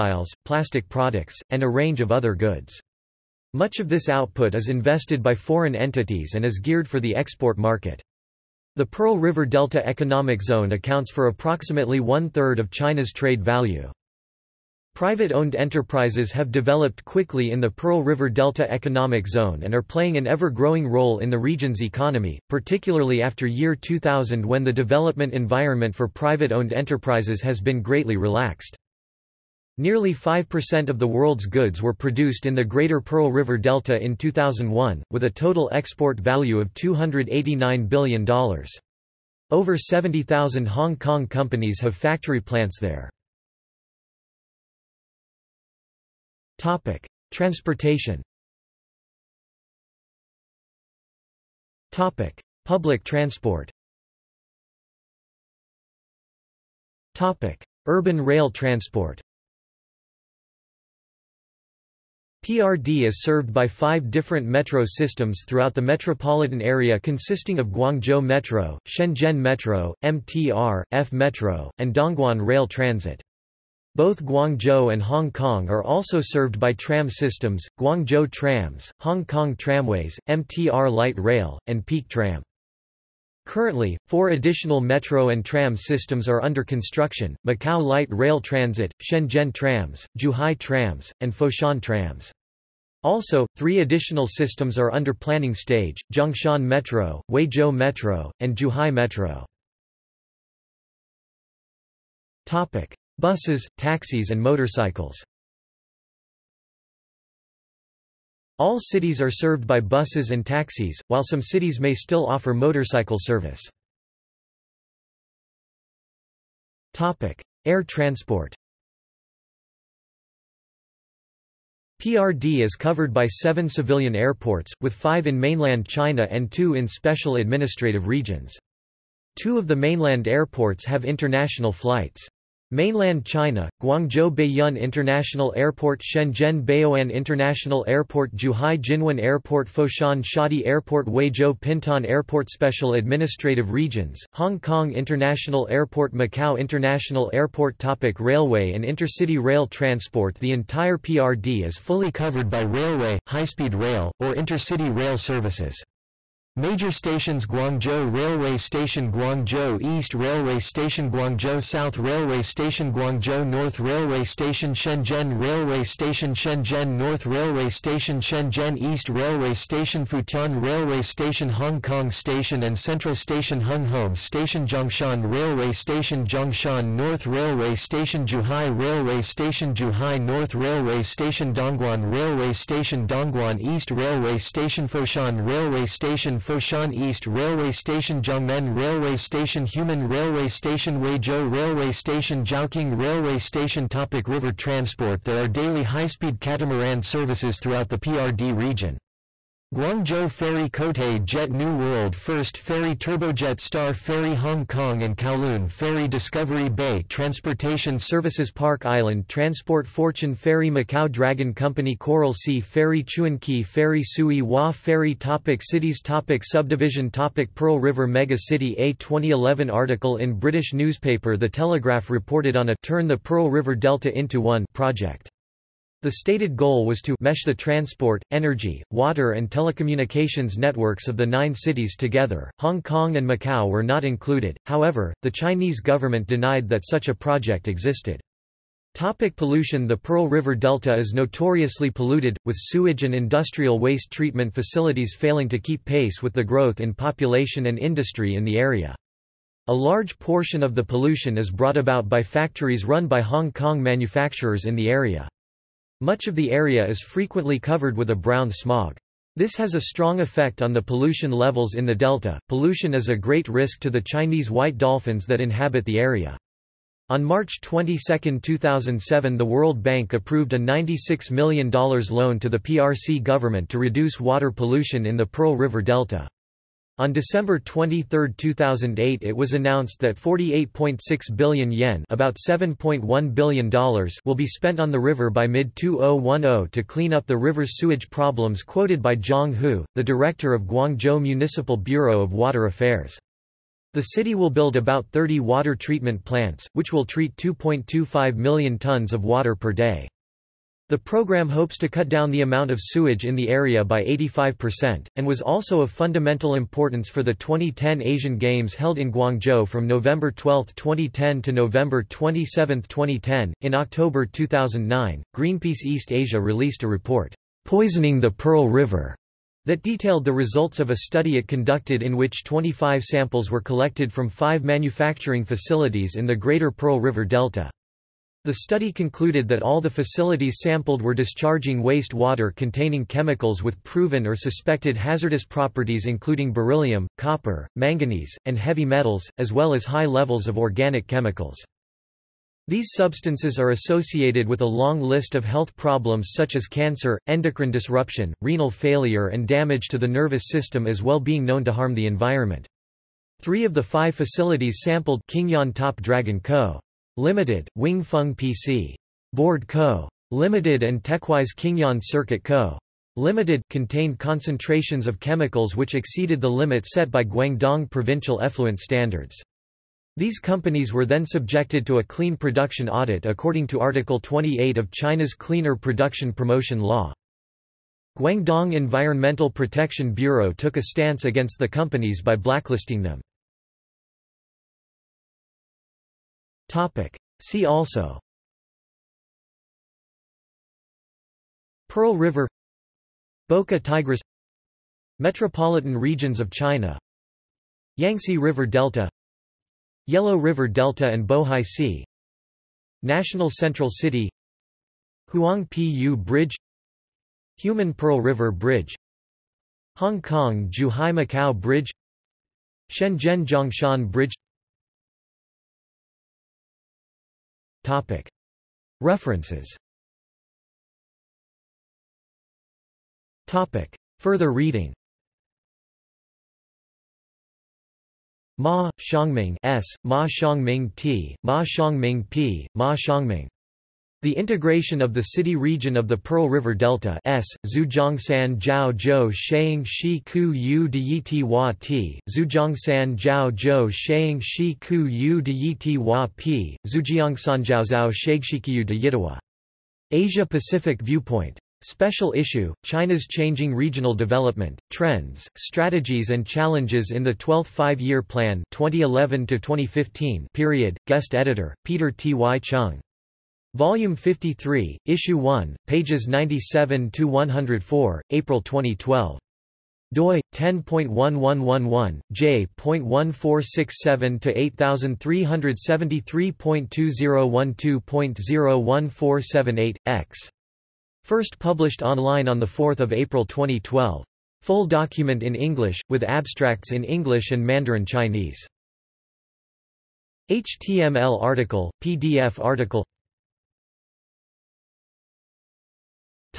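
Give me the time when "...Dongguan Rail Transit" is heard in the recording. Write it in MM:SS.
01:11.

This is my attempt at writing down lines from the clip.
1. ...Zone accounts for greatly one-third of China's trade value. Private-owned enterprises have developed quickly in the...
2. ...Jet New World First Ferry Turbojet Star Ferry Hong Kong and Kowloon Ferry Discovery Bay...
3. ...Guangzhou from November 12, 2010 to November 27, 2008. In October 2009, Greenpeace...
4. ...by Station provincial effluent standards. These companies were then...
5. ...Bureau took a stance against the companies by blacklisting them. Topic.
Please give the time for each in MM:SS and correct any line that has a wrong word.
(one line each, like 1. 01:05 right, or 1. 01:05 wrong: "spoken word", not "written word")
1. 00:10 wrong: "approximately", not "greatly"
2. 03:21 right
3. 05:09 wrong: "2010", not "2008"
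4. 06:07 wrong: "Guangdong", not "Station"
5. 06:20 right.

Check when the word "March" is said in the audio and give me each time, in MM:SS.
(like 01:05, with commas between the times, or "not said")
04:27.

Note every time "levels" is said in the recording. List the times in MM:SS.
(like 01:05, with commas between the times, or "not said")
04:21, 05:40.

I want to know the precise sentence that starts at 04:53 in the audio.
The city will build about 30 water treatment plants, which will treat 2.25 million tons of water per day.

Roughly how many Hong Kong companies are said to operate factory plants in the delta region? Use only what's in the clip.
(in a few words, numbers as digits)
70,000.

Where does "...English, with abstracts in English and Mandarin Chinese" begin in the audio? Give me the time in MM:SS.
08:05.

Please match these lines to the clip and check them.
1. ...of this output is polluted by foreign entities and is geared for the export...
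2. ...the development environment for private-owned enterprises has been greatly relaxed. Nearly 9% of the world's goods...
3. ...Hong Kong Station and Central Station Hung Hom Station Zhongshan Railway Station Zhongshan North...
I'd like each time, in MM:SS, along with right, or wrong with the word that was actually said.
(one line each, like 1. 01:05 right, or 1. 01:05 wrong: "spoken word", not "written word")
1. 00:03 wrong: "invested", not "polluted"
2. 00:24 wrong: "5", not "9"
3. 02:51 right.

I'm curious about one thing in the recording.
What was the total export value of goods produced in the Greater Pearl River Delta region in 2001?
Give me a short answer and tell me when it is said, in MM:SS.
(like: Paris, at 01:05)
$289 billion, at 00:36.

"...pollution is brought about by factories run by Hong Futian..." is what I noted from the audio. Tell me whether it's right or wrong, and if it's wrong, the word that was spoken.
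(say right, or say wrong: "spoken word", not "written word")
wrong: "Kong", not "Futian".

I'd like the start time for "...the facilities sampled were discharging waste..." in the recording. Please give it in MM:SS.
05:29.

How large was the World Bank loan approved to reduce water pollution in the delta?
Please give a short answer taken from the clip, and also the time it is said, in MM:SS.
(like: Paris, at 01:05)
$96 million, at 04:30.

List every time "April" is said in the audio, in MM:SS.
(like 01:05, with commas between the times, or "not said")
07:48, 08:03.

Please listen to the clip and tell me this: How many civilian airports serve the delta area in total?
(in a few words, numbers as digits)
7.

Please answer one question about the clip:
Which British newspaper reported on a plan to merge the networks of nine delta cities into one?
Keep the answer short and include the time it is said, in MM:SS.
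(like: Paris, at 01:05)
The Telegraph, at 03:41.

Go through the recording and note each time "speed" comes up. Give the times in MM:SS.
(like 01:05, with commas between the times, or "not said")
02:33, 03:15.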